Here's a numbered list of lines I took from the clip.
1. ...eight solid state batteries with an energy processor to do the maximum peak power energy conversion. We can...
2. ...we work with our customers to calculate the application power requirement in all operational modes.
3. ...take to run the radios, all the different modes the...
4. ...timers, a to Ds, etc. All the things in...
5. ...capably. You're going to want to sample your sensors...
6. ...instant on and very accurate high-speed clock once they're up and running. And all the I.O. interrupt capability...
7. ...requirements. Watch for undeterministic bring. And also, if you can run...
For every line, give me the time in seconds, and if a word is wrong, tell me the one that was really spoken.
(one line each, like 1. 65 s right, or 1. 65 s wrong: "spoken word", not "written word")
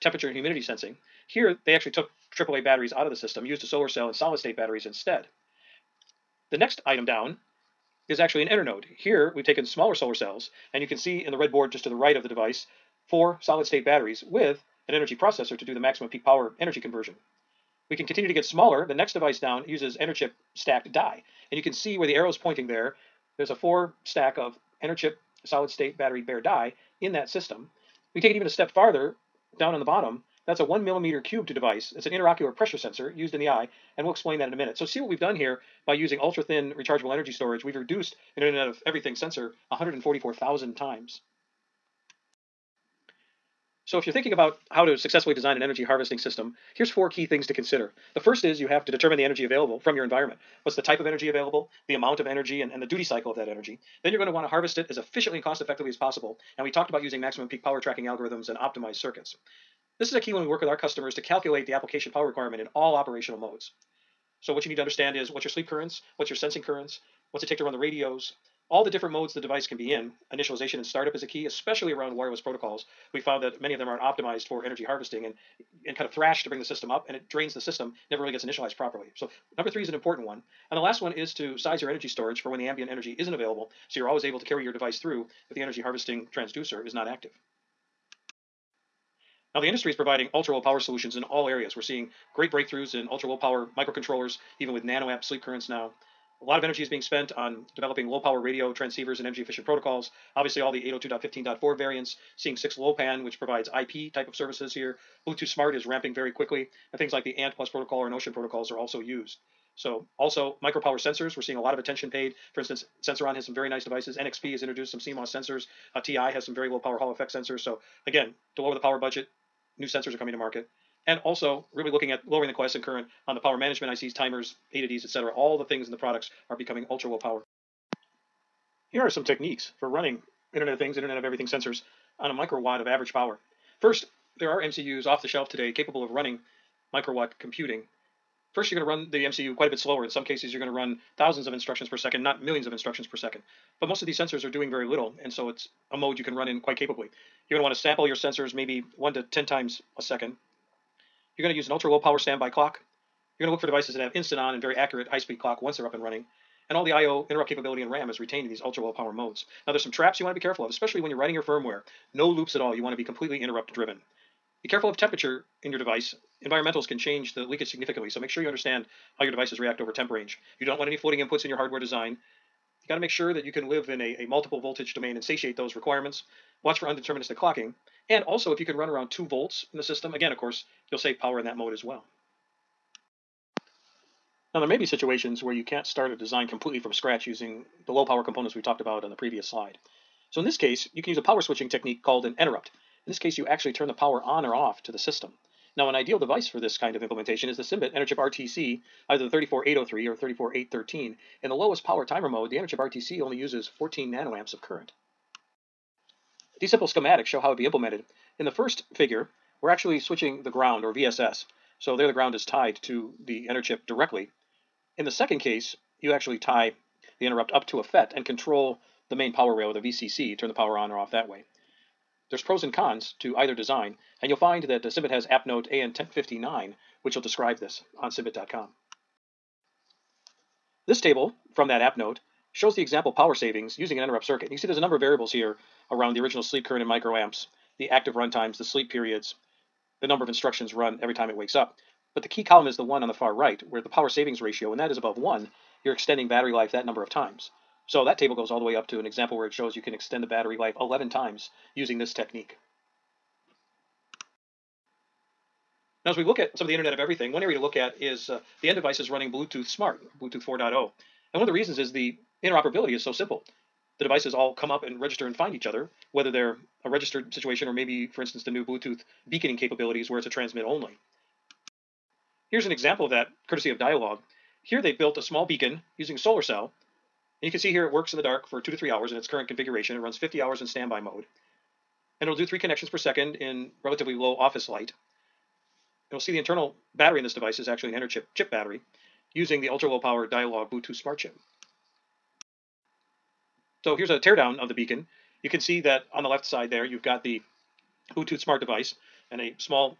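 1. 13 s wrong: "four", not "eight"
2. 60 s right
3. 67 s right
4. 124 s right
5. 146 s right
6. 154 s right
7. 175 s wrong: "clocking", not "bring".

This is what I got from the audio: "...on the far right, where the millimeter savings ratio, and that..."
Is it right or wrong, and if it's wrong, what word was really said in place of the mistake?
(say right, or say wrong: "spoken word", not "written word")
wrong: "power", not "millimeter".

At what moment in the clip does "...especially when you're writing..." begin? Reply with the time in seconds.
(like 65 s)
160 s.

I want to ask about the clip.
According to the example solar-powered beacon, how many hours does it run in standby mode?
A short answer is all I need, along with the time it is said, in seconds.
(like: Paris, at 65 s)
50 hours, at 280 s.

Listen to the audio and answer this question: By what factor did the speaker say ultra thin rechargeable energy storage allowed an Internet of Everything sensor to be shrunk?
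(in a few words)
144,000 times.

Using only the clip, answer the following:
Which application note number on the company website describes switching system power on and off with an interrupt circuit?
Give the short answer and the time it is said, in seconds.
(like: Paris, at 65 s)
AN1059, at 225 s.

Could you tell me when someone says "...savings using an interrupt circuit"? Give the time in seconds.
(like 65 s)
233 s.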